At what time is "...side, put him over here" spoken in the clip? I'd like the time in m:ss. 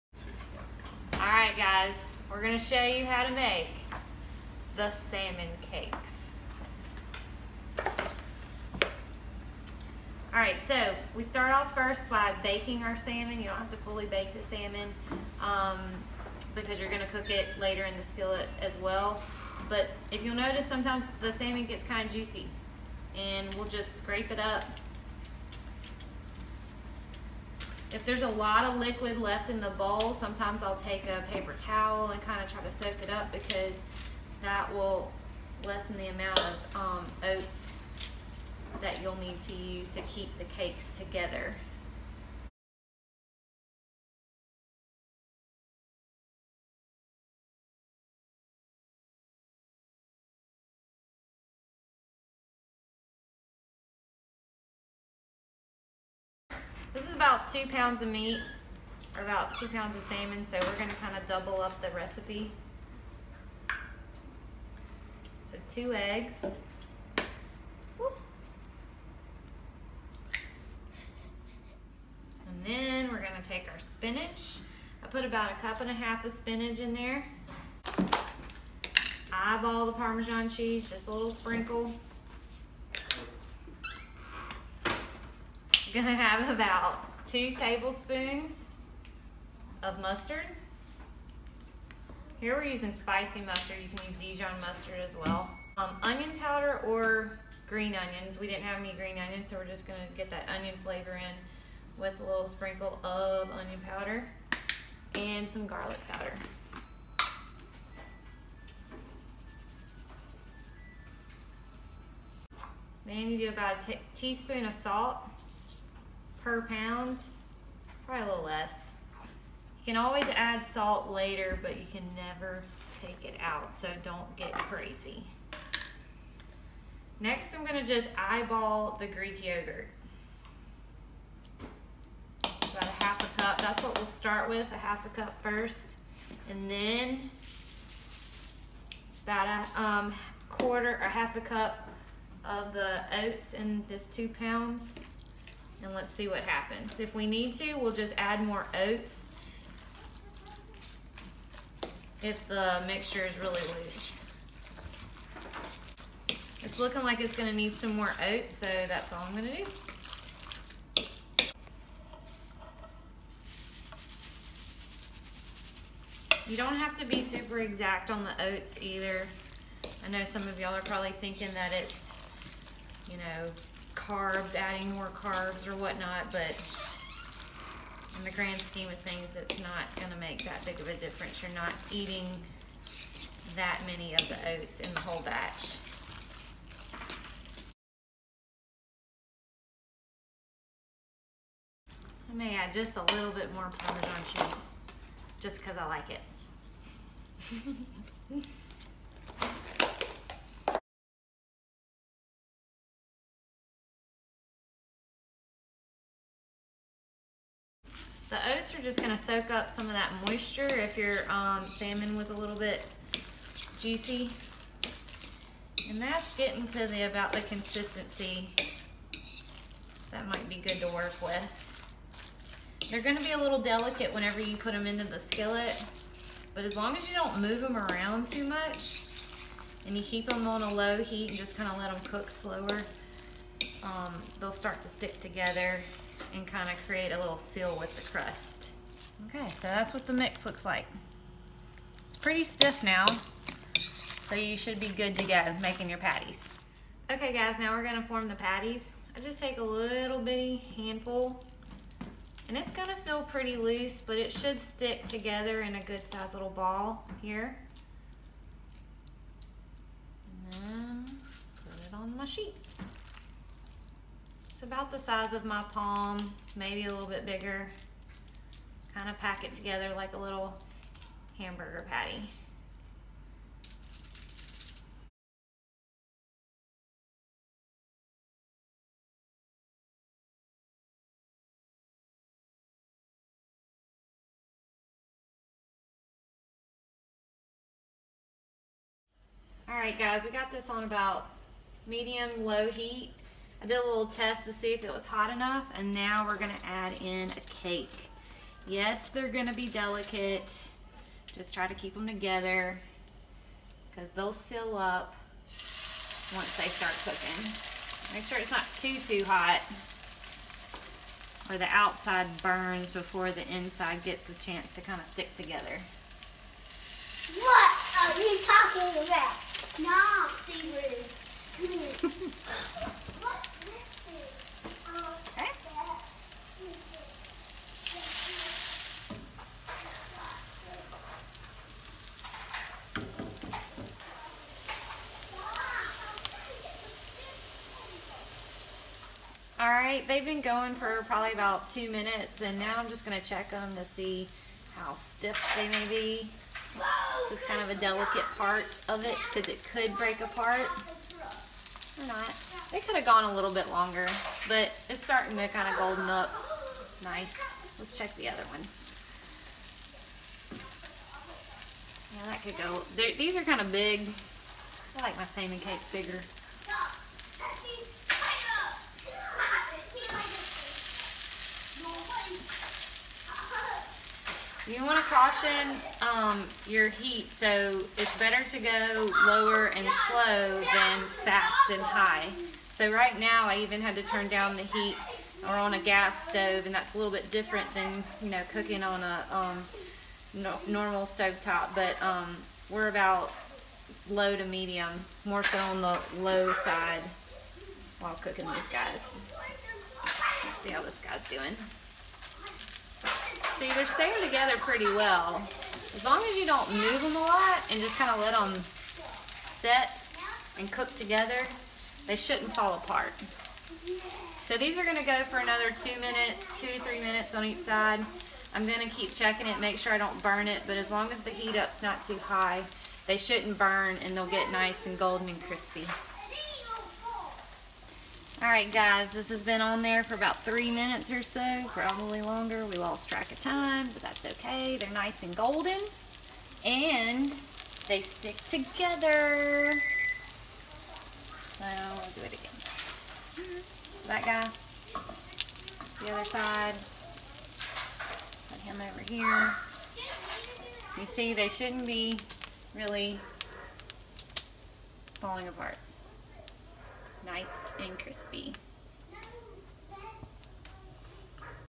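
7:26.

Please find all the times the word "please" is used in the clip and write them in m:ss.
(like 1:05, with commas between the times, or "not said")
not said.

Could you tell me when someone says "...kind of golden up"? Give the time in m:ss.
5:55.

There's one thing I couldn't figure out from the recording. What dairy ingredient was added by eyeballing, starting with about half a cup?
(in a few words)
Greek yogurt.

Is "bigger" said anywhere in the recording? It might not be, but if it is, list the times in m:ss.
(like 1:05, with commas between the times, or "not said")
4:27, 6:05.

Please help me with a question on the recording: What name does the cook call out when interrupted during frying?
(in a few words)
Seaweed.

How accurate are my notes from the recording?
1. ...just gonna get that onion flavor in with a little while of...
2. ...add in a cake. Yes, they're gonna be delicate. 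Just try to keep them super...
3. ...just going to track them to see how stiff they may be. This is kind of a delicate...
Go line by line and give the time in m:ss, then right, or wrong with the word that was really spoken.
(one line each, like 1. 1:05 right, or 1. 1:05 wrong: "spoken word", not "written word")
1. 1:39 wrong: "sprinkle", not "while"
2. 4:56 wrong: "together", not "super"
3. 5:42 wrong: "check", not "track".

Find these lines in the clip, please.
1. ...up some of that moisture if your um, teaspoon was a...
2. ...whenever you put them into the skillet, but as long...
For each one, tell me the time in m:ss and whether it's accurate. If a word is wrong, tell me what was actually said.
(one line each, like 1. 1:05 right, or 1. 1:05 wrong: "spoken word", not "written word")
1. 3:29 wrong: "salmon", not "teaspoon"
2. 3:44 right.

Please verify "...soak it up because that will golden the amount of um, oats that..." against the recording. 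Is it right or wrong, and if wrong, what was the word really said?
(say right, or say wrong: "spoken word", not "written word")
wrong: "lessen", not "golden".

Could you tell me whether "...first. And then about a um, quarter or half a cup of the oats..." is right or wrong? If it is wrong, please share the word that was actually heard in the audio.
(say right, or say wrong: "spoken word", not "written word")
right.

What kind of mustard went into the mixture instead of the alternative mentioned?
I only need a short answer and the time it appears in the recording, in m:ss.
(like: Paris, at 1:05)
spicy mustard, at 1:32.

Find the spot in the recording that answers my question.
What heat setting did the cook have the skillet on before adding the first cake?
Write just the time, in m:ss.
4:51.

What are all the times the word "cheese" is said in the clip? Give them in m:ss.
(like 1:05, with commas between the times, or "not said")
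1:20, 3:14.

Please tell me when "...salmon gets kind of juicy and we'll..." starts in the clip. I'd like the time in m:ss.
0:21.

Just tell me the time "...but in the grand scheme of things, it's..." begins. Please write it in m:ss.
2:56.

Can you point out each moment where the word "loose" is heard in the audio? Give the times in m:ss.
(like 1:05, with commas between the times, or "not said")
2:33, 4:13.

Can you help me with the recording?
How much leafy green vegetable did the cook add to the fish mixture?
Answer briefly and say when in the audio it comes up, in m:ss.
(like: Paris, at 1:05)
a cup and a half, at 1:15.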